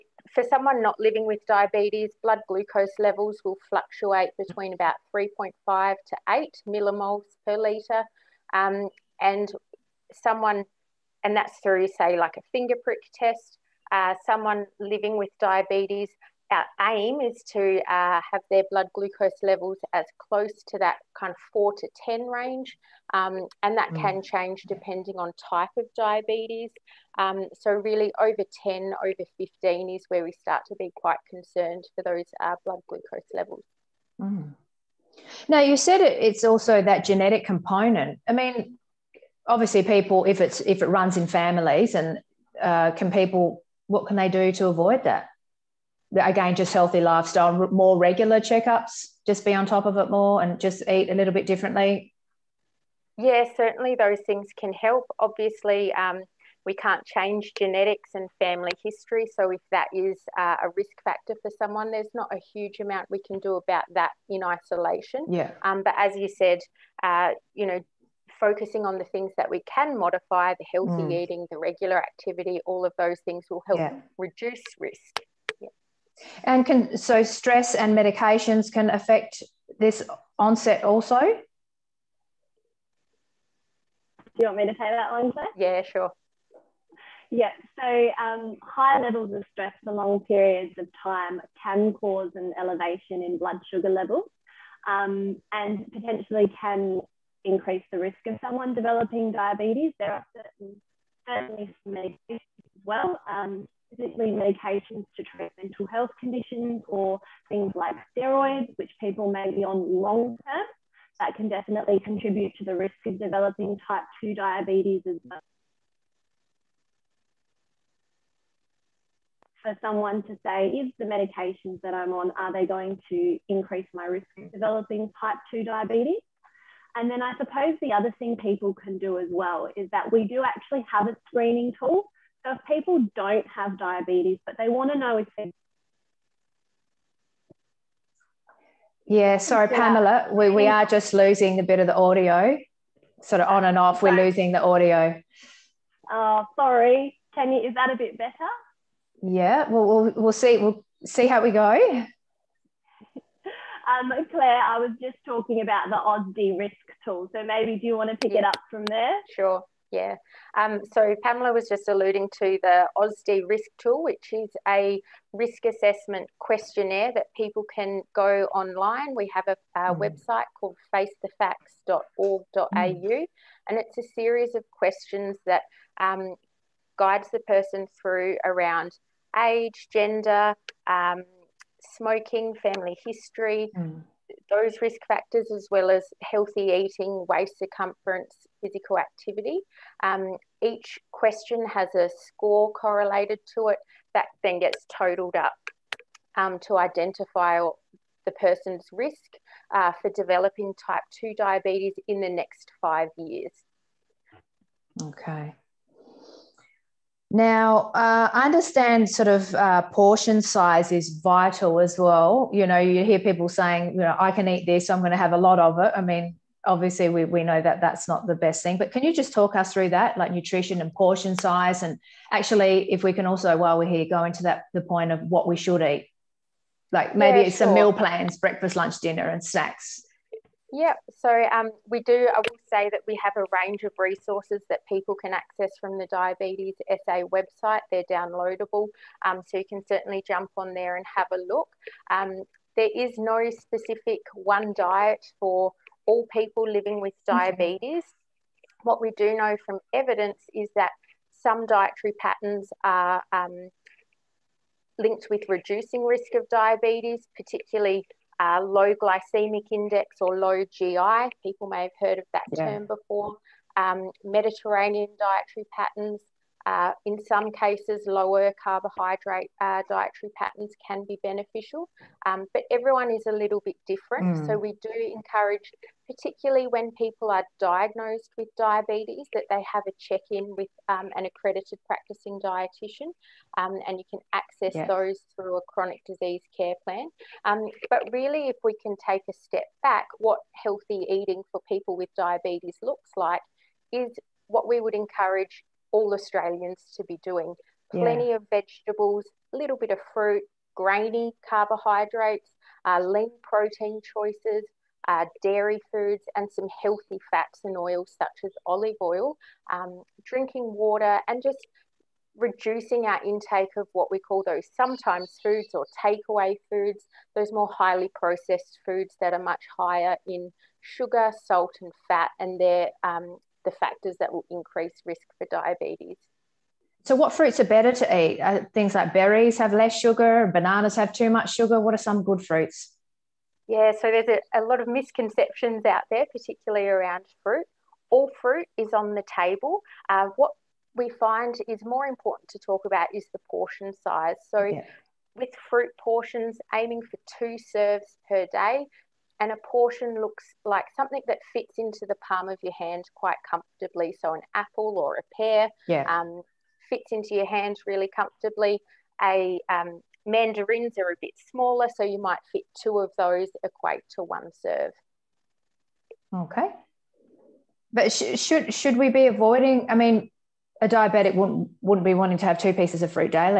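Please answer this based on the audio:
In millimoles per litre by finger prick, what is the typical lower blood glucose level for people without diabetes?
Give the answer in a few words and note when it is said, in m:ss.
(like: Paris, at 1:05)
3.5, at 0:05.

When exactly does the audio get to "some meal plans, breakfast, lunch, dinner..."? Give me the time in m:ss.
3:47.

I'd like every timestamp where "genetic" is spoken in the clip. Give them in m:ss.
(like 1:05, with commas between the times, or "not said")
0:37, 0:57.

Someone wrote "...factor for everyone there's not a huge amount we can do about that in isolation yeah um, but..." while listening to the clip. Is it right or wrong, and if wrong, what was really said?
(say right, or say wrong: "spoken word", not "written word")
wrong: "someone", not "everyone".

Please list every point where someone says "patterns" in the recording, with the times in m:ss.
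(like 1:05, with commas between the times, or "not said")
4:12, 4:25, 4:30.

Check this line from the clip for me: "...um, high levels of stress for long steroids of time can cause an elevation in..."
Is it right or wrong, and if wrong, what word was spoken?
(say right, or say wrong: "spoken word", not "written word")
wrong: "periods", not "steroids".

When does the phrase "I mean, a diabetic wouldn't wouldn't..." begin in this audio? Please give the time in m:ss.
6:09.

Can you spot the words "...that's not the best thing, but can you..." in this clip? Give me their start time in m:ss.
3:37.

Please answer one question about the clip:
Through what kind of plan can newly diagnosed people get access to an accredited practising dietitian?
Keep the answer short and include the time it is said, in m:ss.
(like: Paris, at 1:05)
chronic disease care plan, at 4:45.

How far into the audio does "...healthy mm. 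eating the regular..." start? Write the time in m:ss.
1:10.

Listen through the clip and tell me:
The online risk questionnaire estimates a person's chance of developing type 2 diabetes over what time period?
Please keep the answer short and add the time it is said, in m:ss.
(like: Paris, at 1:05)
5 years, at 3:22.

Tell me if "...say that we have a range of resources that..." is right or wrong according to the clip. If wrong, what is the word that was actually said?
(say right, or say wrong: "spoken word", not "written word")
right.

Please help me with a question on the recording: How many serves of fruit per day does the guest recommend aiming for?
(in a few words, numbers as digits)
2 serves.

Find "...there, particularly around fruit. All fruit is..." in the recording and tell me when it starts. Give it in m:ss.
5:36.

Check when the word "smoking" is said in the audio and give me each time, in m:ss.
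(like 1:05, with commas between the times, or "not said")
3:01.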